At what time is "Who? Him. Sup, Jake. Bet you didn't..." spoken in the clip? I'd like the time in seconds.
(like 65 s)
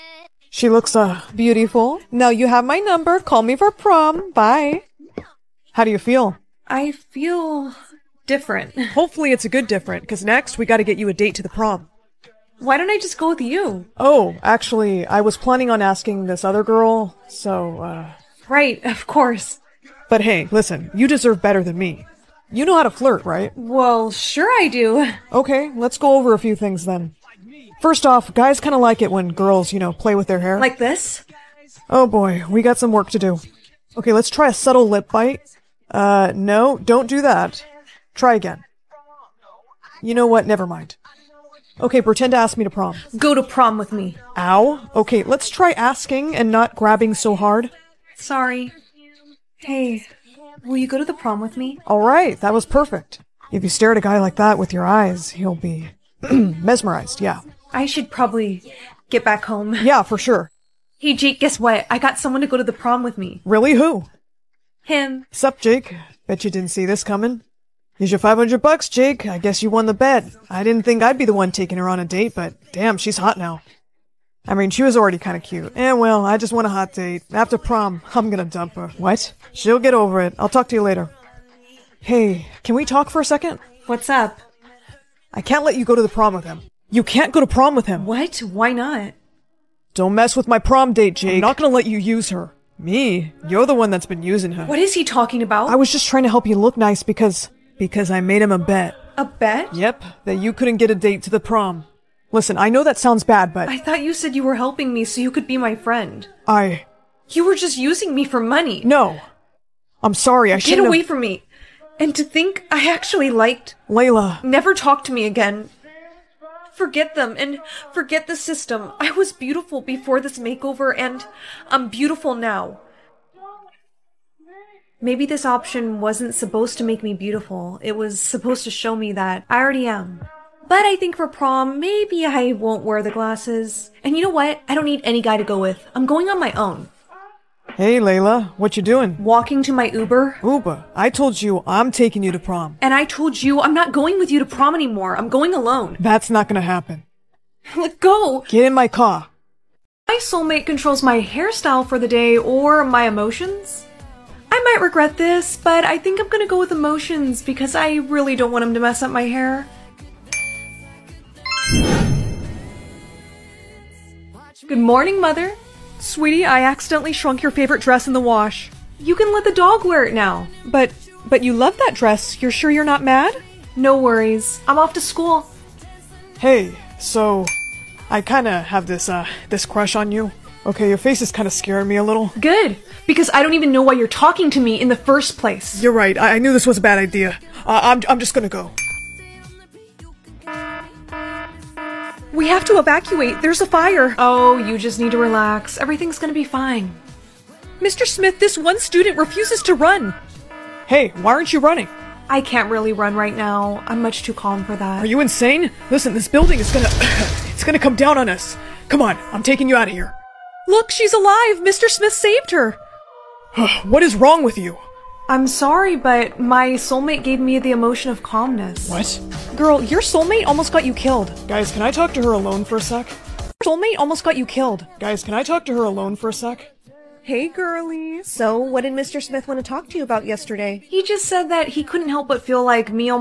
63 s.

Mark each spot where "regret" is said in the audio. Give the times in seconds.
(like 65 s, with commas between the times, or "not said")
154 s.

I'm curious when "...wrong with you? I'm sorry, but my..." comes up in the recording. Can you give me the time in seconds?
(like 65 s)
214 s.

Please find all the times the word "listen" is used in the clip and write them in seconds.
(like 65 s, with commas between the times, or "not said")
20 s, 102 s, 205 s.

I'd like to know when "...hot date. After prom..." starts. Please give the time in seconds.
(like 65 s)
76 s.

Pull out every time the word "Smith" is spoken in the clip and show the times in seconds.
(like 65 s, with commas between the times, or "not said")
198 s, 211 s, 229 s.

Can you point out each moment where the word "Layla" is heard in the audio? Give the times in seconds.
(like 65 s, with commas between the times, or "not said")
113 s, 137 s.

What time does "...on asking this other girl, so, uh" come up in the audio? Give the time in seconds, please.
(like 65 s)
15 s.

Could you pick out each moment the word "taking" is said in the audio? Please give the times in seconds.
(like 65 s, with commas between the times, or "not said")
71 s, 141 s, 209 s.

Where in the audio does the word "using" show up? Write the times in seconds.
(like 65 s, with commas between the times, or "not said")
94 s, 107 s.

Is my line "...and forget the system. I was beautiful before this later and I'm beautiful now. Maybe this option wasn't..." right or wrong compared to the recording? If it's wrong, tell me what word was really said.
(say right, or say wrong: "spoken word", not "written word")
wrong: "makeover", not "later".